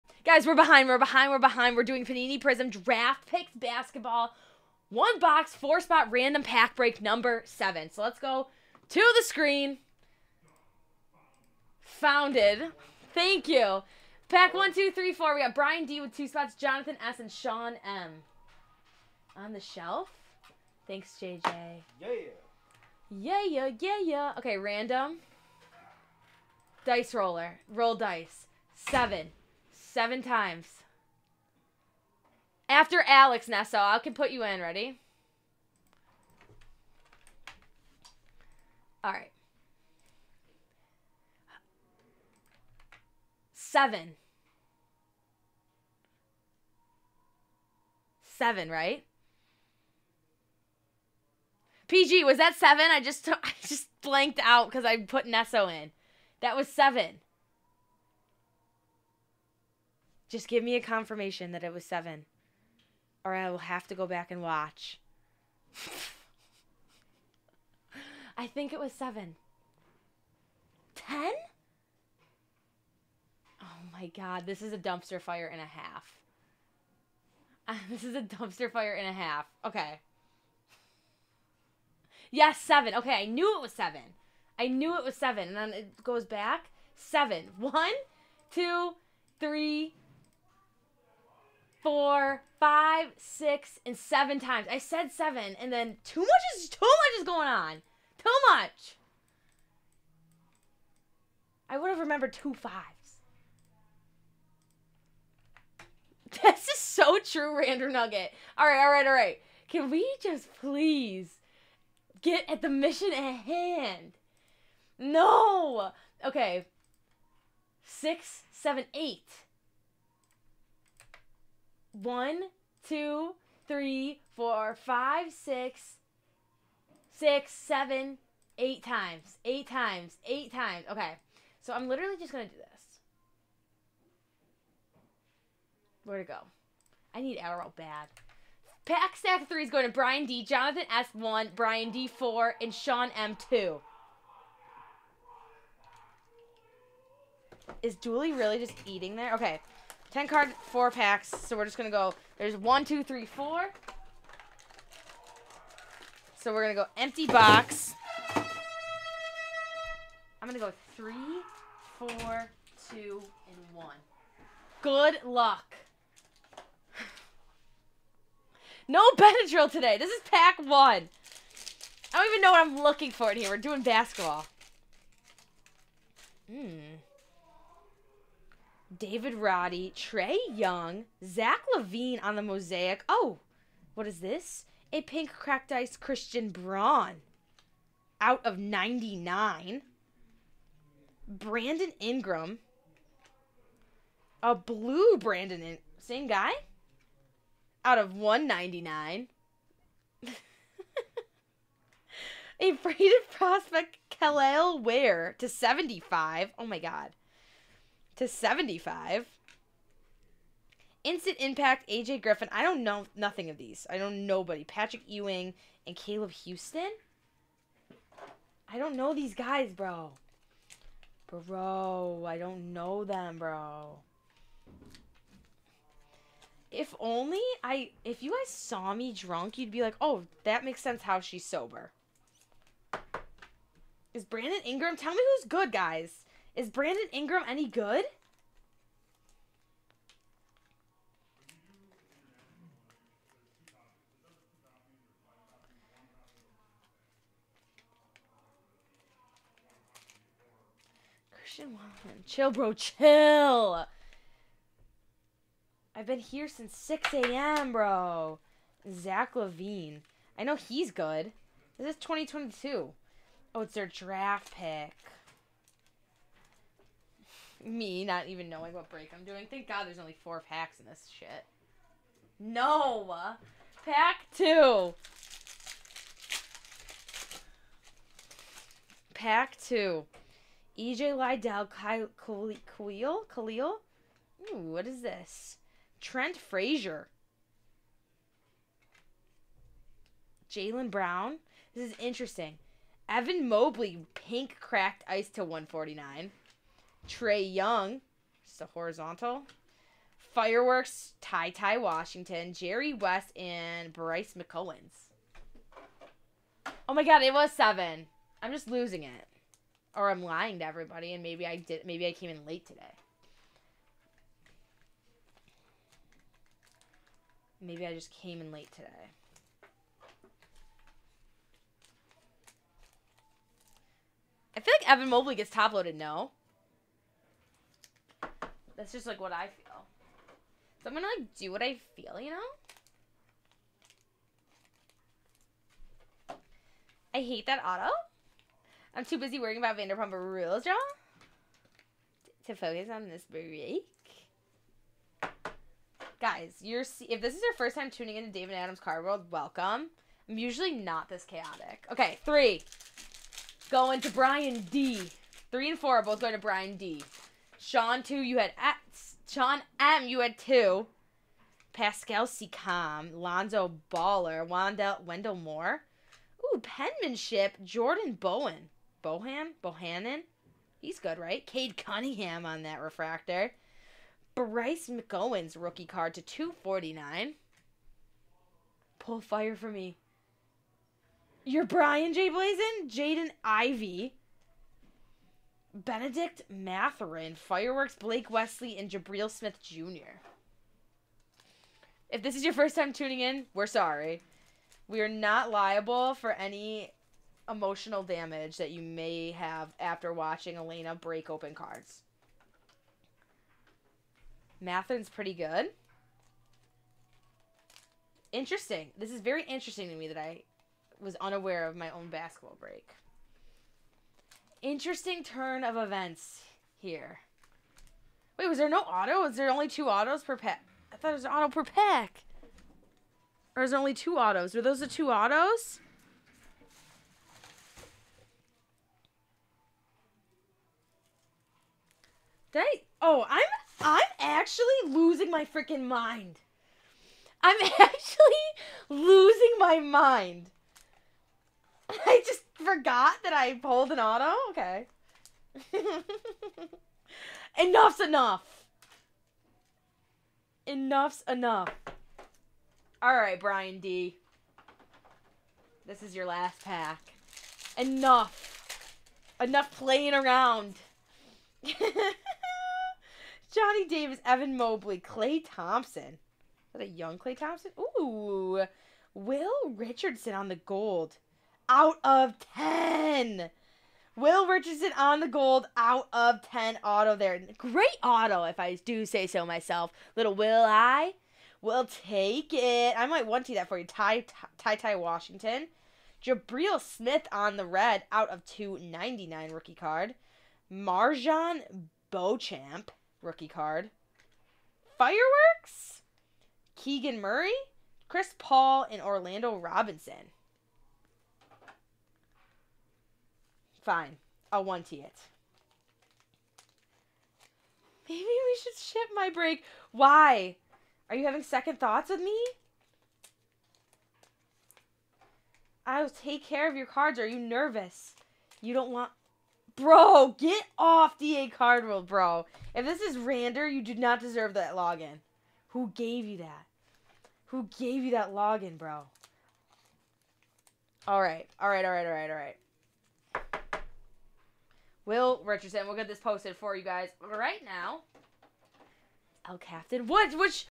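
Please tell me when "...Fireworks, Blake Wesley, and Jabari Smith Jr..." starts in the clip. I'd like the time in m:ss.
6:27.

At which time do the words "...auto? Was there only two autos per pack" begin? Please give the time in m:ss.
6:58.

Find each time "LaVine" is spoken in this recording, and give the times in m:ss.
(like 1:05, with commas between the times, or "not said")
3:01, 4:19.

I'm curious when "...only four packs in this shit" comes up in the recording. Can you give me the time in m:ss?
4:29.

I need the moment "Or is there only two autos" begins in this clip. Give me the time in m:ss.
7:03.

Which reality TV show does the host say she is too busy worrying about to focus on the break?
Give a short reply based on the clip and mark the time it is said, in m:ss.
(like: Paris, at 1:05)
Vanderpump Rules, at 5:39.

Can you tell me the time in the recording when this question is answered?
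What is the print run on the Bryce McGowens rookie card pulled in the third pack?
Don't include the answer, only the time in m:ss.
6:16.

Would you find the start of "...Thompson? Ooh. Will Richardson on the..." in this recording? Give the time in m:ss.
7:47.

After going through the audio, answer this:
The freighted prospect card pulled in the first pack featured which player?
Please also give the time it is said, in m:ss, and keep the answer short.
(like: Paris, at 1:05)
Kel'el Ware, at 3:24.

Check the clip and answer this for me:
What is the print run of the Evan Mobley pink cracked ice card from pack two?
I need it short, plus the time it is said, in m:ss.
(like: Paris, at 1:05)
149, at 4:55.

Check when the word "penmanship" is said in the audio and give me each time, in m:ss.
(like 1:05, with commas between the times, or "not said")
6:06.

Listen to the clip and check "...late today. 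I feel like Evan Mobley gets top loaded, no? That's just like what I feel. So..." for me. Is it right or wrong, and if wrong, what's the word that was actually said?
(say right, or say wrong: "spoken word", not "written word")
right.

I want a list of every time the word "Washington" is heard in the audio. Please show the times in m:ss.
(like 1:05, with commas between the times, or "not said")
5:01, 8:04.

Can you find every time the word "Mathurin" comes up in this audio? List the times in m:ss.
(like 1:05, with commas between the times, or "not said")
6:26, 6:44.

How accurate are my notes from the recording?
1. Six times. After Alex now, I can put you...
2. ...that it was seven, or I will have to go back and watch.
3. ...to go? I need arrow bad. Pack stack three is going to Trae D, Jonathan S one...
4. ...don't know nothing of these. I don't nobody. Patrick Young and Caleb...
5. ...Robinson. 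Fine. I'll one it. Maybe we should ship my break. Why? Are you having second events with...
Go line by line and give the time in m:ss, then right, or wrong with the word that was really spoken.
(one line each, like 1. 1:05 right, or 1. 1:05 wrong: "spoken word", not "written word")
1. 0:29 wrong: "Seven", not "Six"
2. 1:01 right
3. 2:16 wrong: "Brian", not "Trae"
4. 3:32 wrong: "Ewing", not "Young"
5. 8:19 wrong: "thoughts", not "events".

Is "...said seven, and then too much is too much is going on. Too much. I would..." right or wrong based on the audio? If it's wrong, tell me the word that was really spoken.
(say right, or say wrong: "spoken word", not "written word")
right.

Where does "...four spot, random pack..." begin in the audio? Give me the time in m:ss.
0:05.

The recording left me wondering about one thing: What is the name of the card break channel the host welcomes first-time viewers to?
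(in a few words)
David Adams Card World.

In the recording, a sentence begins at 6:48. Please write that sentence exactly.
This is very interesting to me that I was unaware of my own basketball break.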